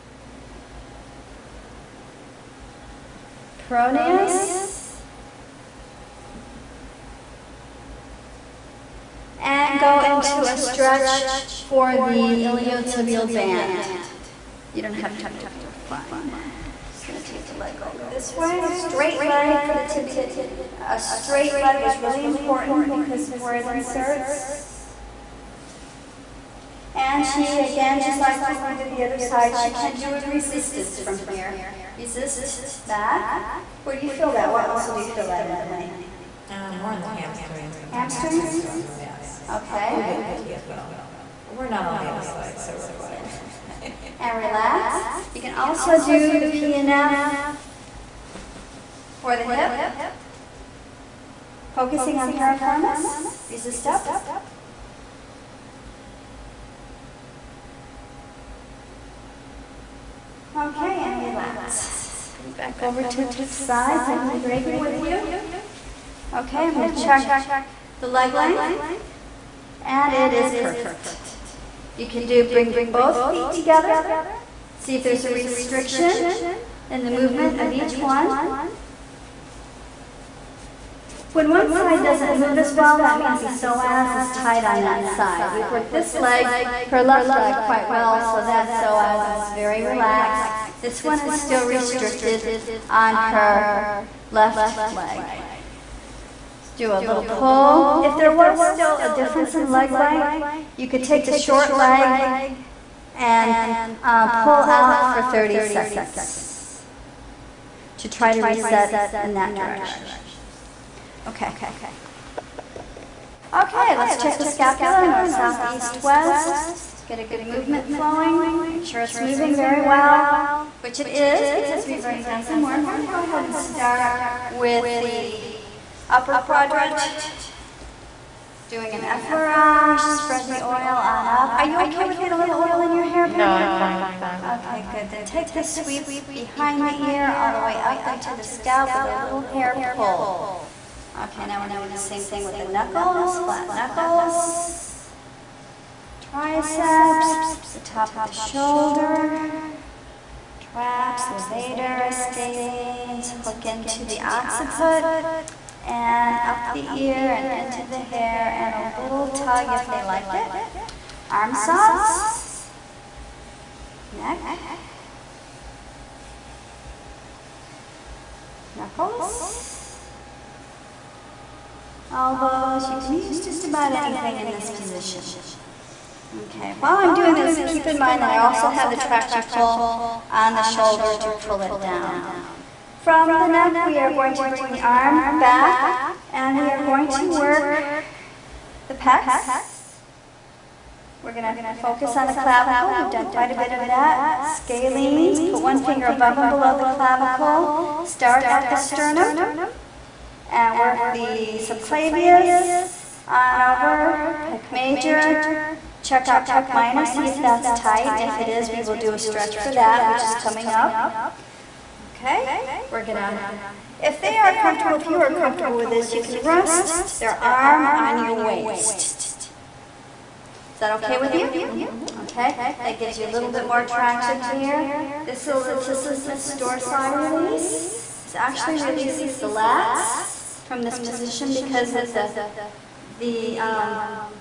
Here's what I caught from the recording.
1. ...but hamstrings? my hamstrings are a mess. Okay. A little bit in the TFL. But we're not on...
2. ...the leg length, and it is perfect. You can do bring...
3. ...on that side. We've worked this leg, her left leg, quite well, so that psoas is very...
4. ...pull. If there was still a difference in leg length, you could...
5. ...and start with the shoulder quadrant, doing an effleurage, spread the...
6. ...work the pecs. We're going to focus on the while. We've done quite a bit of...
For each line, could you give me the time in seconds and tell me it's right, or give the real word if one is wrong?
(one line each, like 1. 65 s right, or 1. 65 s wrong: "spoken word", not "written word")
1. 37 s right
2. 67 s right
3. 84 s right
4. 97 s right
5. 123 s wrong: "upper", not "shoulder"
6. 187 s wrong: "clavicle", not "while".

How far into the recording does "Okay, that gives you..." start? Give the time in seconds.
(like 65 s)
222 s.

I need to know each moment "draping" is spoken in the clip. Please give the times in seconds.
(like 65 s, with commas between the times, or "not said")
64 s.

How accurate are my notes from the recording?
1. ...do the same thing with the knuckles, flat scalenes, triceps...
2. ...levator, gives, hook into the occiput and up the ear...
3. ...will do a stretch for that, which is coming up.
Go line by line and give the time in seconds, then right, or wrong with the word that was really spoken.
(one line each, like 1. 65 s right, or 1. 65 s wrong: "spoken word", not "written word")
1. 141 s wrong: "knuckles", not "scalenes"
2. 151 s wrong: "scalenes", not "gives"
3. 208 s right.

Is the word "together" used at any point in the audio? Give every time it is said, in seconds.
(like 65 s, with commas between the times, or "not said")
73 s.